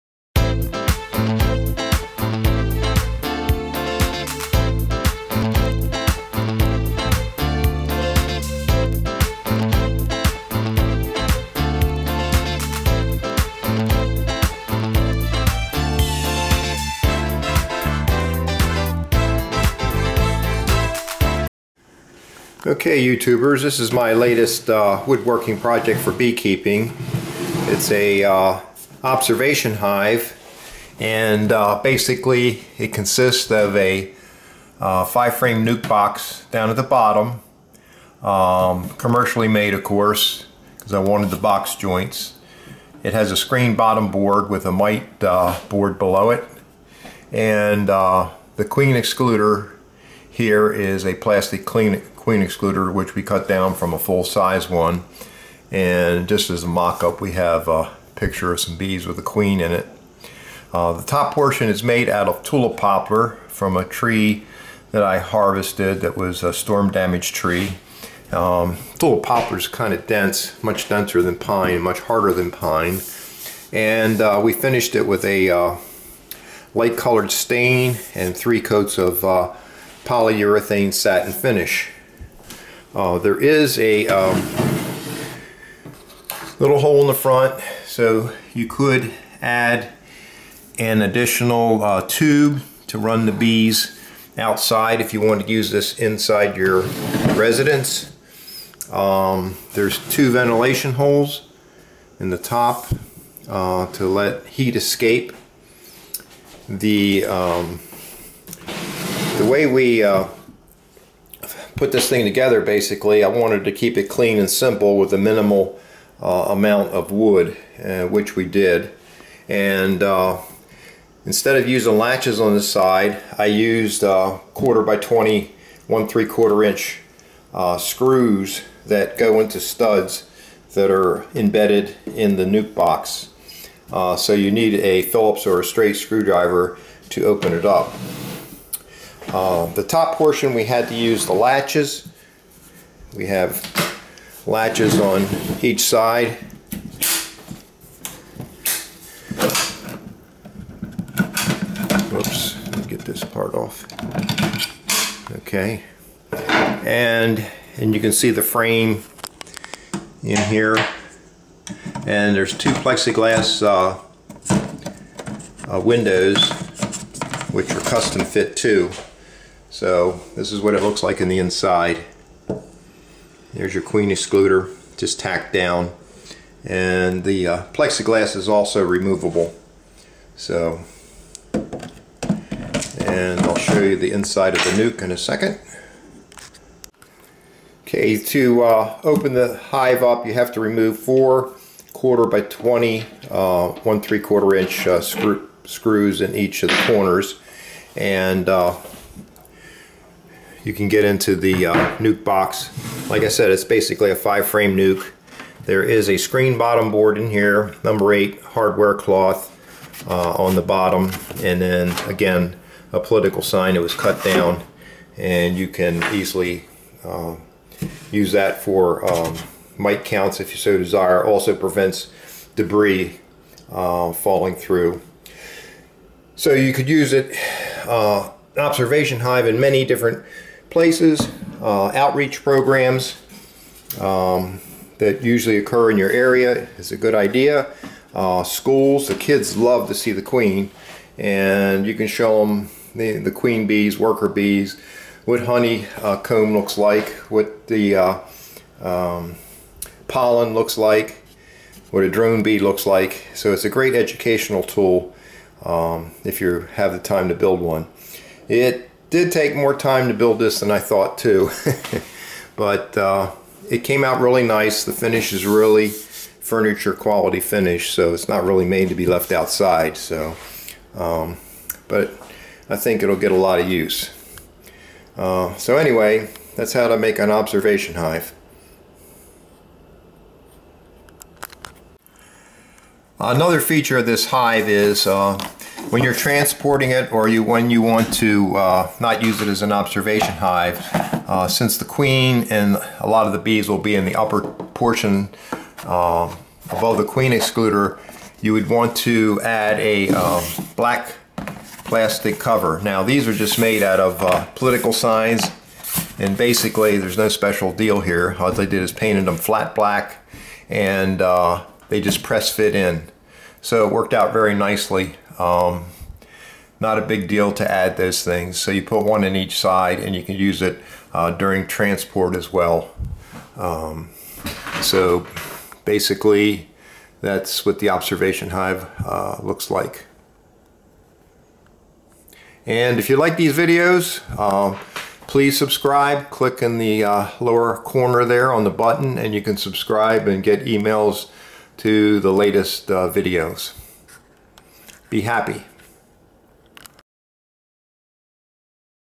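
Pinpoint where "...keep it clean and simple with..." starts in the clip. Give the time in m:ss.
1:53.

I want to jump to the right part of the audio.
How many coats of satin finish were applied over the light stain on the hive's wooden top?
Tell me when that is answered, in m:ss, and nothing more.
1:18.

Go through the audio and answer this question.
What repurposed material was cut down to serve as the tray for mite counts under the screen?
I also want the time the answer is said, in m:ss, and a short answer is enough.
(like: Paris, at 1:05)
A political sign, at 3:32.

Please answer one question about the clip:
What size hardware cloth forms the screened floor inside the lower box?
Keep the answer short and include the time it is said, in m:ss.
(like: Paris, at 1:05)
Number 8, at 3:27.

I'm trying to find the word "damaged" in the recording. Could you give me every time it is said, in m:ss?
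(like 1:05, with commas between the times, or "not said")
1:06.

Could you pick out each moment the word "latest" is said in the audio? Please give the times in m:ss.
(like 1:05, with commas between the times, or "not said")
0:24, 5:42.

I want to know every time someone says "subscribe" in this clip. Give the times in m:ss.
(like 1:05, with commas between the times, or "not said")
5:35, 5:39.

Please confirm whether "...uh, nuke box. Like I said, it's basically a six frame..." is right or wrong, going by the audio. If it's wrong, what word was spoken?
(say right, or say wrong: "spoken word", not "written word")
wrong: "five", not "six".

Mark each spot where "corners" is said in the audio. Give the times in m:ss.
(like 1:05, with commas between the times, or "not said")
3:16, 5:37.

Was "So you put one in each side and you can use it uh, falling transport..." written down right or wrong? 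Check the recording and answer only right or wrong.
wrong.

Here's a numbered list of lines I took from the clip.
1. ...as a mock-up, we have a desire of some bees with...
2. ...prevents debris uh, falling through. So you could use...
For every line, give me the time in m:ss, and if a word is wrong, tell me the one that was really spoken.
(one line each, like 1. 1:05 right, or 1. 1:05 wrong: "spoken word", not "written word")
1. 0:56 wrong: "picture", not "desire"
2. 3:41 right.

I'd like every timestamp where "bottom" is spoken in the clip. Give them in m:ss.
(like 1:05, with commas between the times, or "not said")
0:36, 0:43, 3:26, 3:30.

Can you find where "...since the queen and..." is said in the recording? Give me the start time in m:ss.
4:51.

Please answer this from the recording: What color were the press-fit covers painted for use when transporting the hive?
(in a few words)
Flat black.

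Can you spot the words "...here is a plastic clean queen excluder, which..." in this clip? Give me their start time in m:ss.
0:50.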